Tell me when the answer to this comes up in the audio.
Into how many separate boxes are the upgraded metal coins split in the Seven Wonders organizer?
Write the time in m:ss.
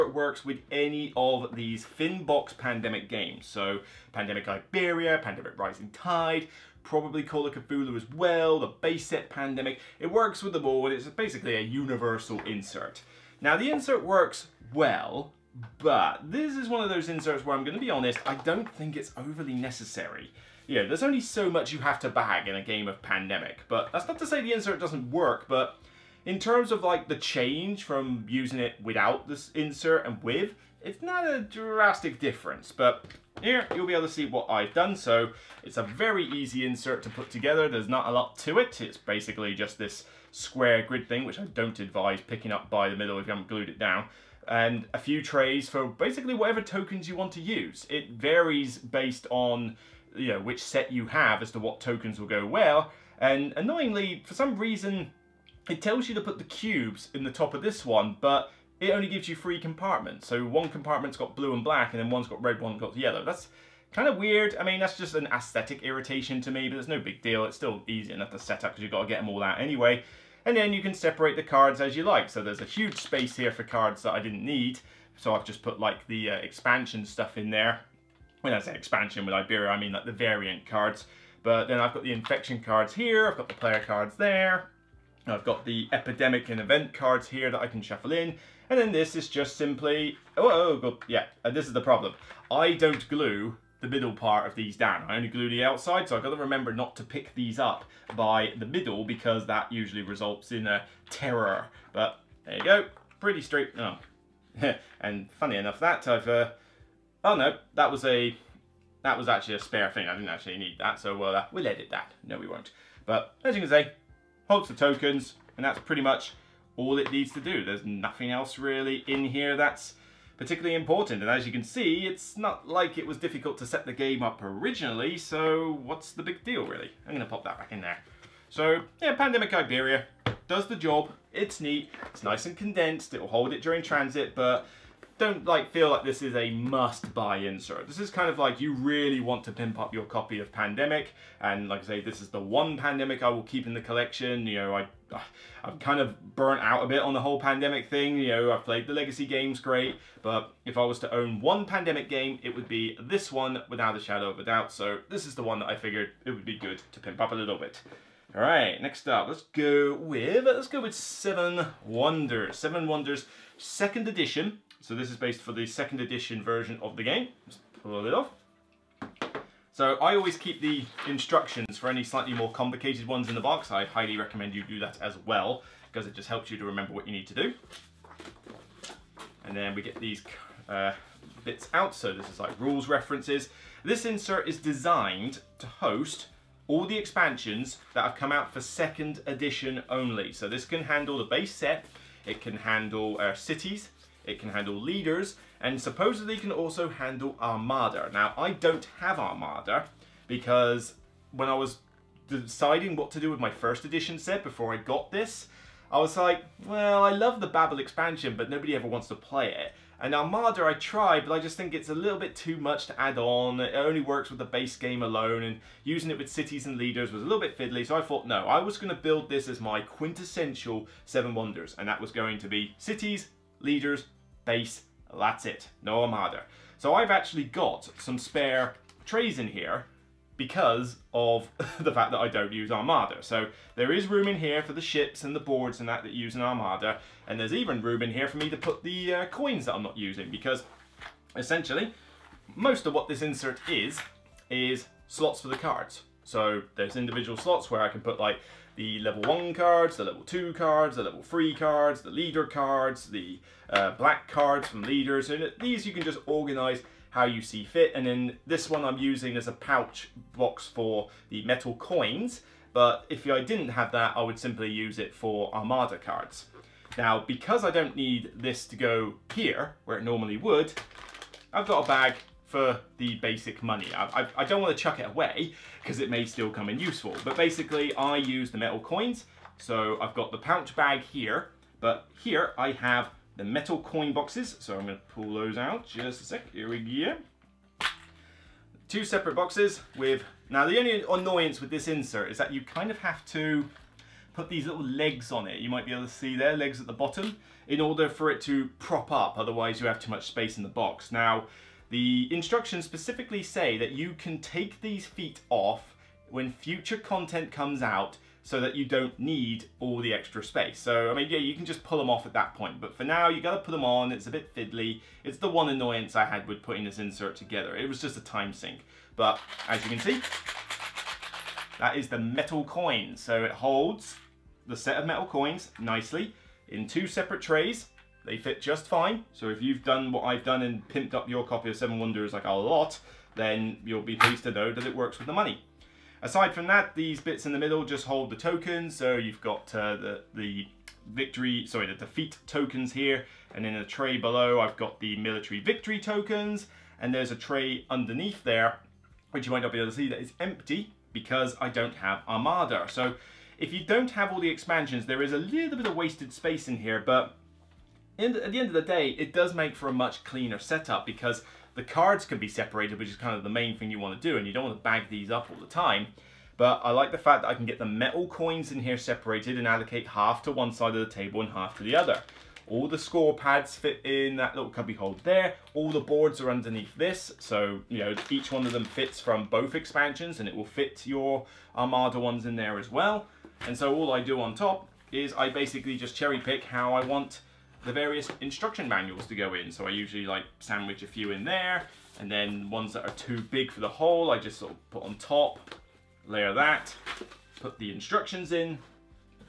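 4:48.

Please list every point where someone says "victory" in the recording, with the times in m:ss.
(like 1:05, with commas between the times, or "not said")
5:41, 5:45.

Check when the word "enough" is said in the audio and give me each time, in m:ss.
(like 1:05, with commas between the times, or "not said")
1:08, 1:45.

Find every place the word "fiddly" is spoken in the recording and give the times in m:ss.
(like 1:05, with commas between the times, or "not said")
3:37, 5:14.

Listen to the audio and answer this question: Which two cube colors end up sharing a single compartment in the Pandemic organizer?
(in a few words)
Blue and black.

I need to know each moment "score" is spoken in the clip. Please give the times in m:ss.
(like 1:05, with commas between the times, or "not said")
6:12.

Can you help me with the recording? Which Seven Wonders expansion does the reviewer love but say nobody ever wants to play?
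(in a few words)
Babel.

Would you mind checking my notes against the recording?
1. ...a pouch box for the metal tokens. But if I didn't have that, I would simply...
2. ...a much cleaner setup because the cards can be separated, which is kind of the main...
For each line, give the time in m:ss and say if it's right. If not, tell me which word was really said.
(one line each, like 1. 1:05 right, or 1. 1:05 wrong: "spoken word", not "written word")
1. 4:19 wrong: "coins", not "tokens"
2. 5:59 right.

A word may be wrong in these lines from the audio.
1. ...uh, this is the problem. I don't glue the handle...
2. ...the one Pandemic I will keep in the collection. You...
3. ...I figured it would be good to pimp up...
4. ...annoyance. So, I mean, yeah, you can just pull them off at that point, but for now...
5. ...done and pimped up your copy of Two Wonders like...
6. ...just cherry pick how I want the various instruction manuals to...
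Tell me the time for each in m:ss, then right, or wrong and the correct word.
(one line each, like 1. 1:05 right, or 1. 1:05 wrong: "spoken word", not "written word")
1. 1:31 wrong: "middle", not "handle"
2. 2:22 right
3. 2:35 right
4. 5:10 wrong: "space", not "annoyance"
5. 5:30 wrong: "Seven", not "Two"
6. 6:25 right.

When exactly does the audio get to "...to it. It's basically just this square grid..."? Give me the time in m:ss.
0:38.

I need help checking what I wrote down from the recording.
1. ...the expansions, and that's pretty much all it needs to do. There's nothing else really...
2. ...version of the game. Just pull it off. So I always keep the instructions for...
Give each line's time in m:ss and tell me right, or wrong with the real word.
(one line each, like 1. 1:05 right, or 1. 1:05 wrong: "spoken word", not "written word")
1. 1:54 wrong: "tokens", not "expansions"
2. 2:46 right.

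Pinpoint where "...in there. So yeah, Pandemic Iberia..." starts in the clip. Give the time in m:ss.
2:07.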